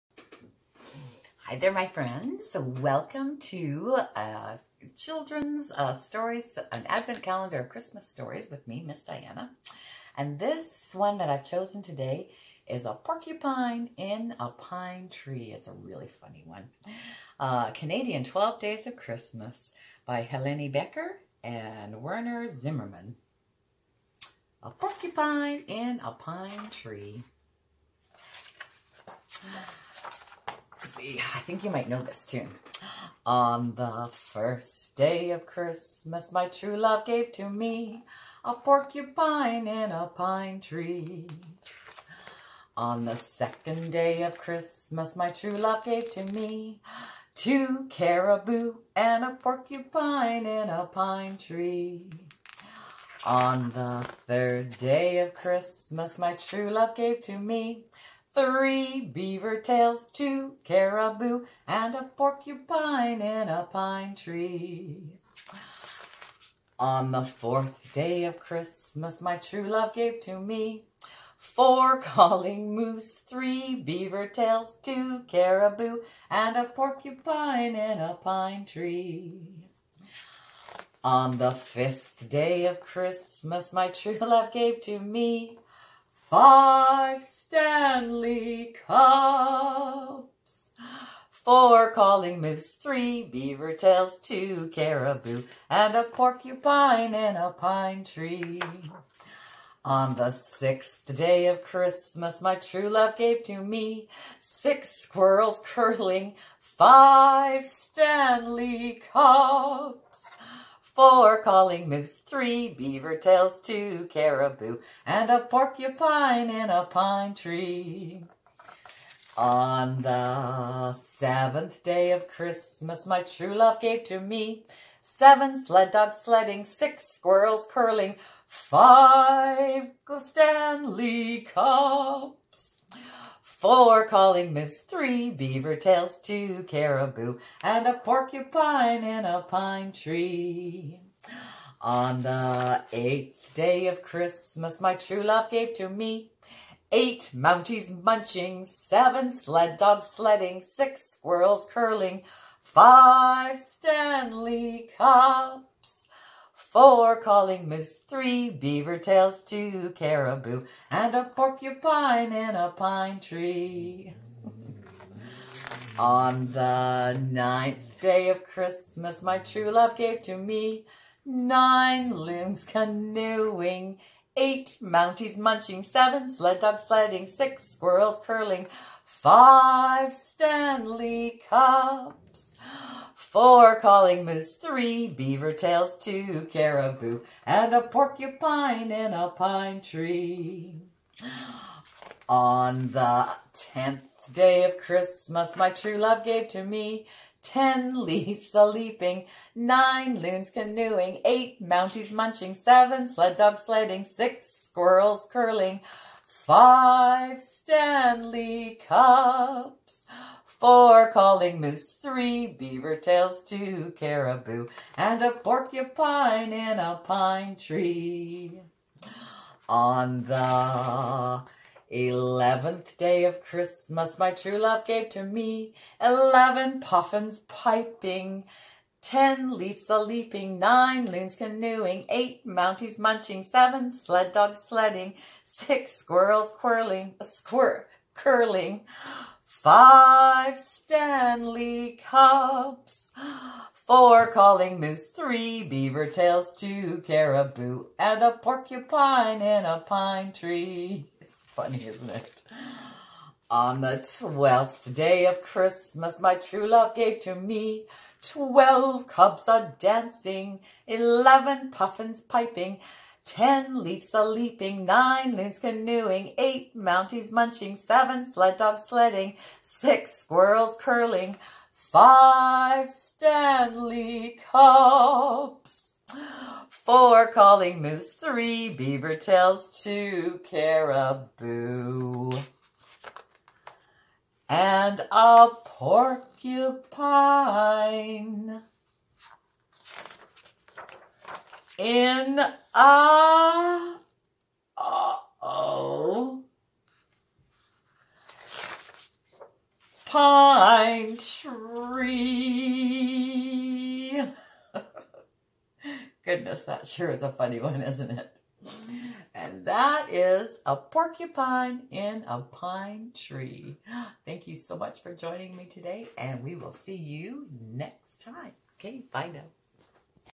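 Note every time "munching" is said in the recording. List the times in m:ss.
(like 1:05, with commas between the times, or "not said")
2:28, 2:55, 3:22, 3:52, 4:27.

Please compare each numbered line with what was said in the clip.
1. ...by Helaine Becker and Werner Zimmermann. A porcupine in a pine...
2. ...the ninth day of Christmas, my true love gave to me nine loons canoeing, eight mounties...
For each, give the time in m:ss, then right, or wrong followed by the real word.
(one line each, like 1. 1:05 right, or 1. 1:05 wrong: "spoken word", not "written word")
1. 0:20 right
2. 2:46 right.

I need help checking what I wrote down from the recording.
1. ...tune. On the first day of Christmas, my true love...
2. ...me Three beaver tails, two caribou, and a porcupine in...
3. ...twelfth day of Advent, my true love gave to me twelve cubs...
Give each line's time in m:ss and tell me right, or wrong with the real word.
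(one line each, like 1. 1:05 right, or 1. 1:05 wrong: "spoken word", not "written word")
1. 0:32 right
2. 0:57 right
3. 4:14 wrong: "Christmas", not "Advent".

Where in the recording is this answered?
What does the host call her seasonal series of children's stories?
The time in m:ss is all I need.
0:06.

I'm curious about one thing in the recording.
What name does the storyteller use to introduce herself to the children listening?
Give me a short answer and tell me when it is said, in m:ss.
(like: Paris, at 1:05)
Miss Diana, at 0:08.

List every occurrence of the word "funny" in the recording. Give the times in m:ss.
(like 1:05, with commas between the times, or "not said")
0:16, 4:11, 5:07.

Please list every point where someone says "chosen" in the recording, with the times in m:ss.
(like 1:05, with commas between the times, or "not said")
0:11.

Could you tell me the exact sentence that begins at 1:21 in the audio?
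On the fifth day of Christmas, my true love gave to me Five Stanley Cups.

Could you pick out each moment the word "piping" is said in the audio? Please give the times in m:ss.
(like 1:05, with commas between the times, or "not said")
3:47, 4:22.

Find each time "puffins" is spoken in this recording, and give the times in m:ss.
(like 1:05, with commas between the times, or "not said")
3:46, 4:21.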